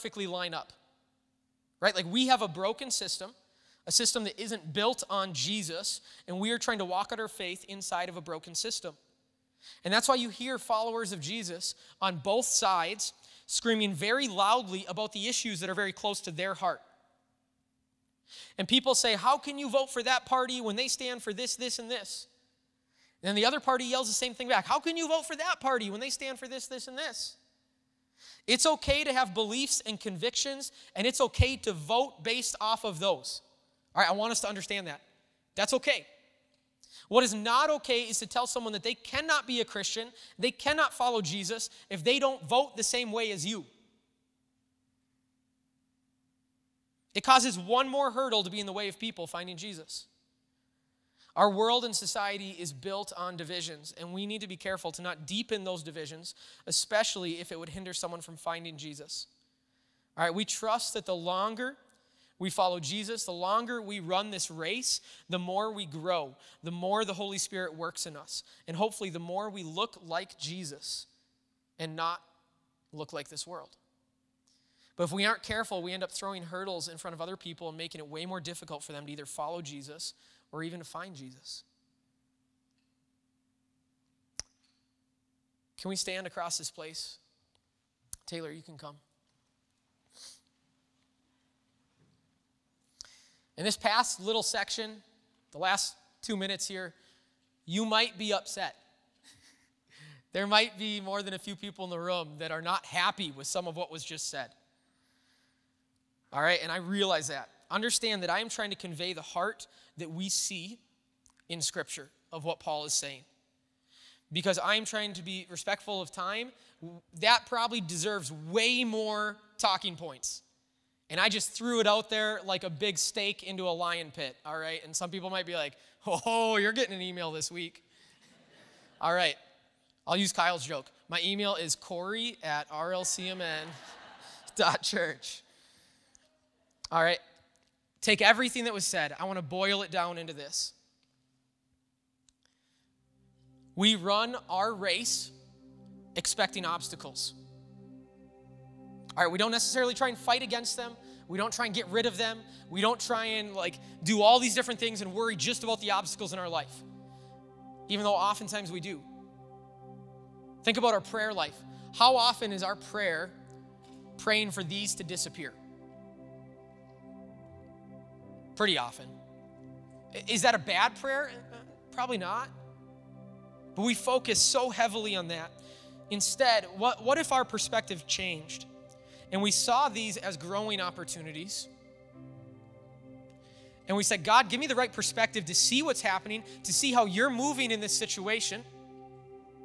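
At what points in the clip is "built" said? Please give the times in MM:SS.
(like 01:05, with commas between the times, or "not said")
00:04, 00:52.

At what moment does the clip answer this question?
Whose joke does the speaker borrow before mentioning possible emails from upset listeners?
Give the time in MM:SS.
02:10.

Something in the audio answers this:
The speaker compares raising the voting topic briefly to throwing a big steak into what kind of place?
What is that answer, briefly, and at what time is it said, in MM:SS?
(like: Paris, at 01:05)
A lion pit, at 02:03.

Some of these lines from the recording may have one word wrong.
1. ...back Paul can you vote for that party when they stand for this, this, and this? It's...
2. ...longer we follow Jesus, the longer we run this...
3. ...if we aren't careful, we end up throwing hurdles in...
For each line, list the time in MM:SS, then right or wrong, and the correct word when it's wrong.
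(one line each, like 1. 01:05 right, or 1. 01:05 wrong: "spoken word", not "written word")
1. 00:24 wrong: "How", not "Paul"
2. 01:01 right
3. 01:15 right.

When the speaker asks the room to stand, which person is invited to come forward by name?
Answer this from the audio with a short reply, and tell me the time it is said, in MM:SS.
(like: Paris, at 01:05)
Taylor, at 01:28.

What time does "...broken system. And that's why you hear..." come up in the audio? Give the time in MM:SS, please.
00:08.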